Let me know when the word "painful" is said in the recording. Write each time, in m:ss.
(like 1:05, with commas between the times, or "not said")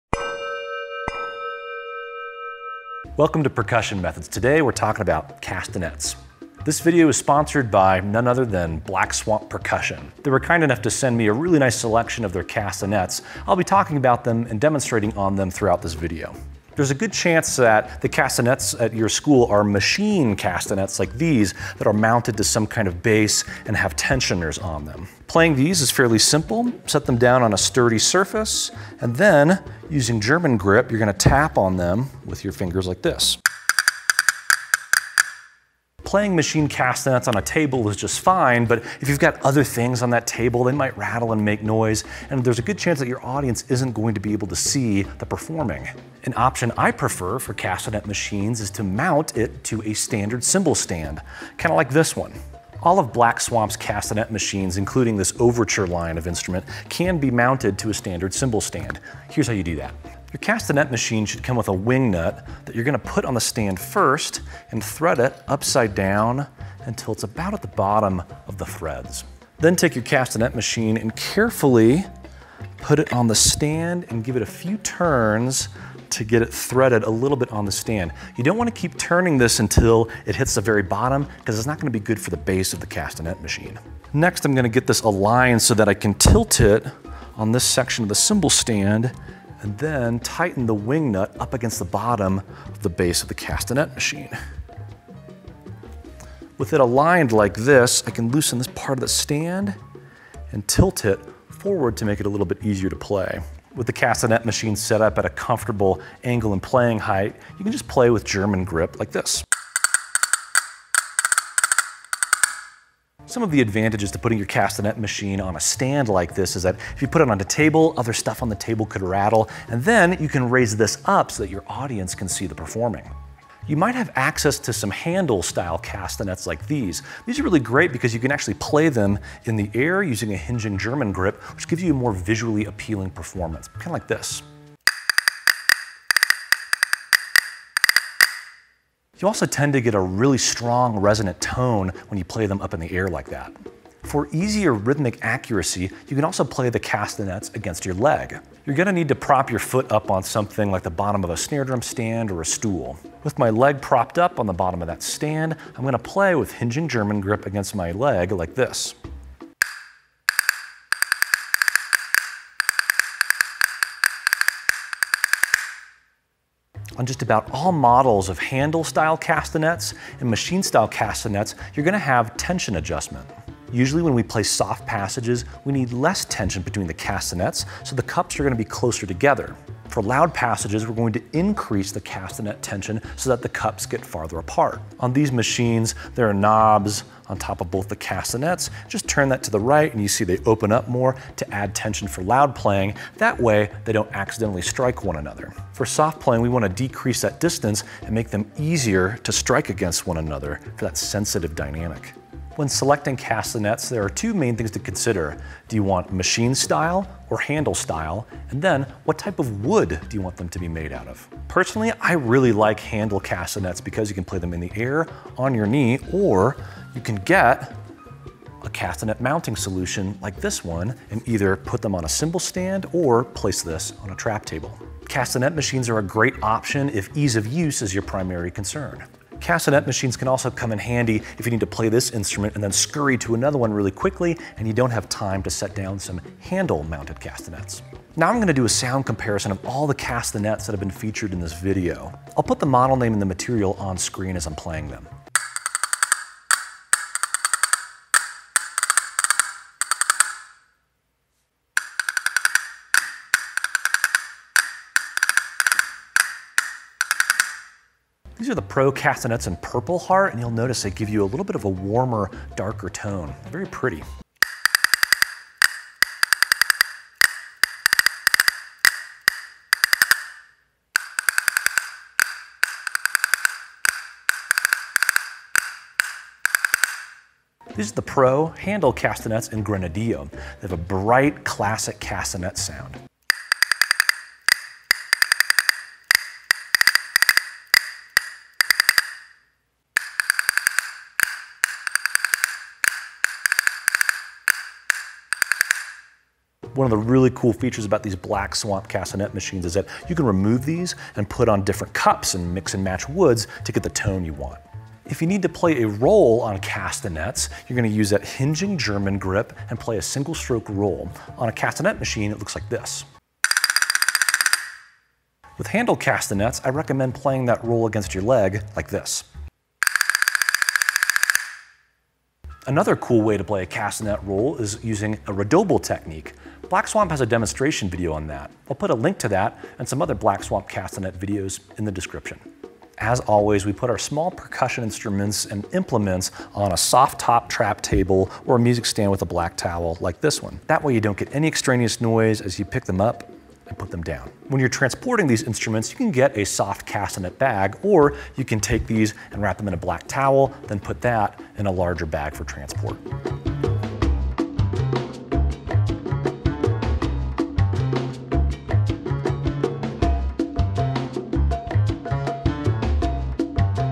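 not said.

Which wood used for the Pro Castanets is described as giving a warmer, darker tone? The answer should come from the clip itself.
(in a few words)
Purpleheart.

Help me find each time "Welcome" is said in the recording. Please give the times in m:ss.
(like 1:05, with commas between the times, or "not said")
0:03.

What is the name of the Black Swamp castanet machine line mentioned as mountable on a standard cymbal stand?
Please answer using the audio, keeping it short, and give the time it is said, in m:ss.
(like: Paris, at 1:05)
Overture, at 0:55.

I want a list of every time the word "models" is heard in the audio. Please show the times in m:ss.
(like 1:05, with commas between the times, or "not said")
2:47, 4:02.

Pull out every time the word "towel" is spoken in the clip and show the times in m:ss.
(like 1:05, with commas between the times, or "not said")
5:39, 5:50.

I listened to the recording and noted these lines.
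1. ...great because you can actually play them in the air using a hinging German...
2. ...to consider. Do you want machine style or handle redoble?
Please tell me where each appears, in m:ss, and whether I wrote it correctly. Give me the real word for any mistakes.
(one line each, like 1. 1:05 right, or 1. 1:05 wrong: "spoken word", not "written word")
1. 2:07 right
2. 3:24 wrong: "style", not "redoble".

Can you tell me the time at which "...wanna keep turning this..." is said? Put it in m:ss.
1:18.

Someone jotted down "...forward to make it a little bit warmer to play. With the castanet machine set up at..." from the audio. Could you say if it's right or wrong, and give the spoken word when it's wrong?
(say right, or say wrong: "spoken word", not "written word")
wrong: "easier", not "warmer".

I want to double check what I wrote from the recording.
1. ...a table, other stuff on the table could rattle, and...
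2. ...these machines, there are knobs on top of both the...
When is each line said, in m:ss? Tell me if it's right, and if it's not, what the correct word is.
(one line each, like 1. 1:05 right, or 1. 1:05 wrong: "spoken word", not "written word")
1. 1:57 right
2. 3:05 right.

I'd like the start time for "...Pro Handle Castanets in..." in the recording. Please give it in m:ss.
4:38.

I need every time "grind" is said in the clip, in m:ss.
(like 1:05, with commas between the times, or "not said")
not said.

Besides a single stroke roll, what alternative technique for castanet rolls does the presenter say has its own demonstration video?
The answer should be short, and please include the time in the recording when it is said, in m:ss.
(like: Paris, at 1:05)
redoble, at 5:25.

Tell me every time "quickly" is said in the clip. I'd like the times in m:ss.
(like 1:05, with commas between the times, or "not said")
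3:53.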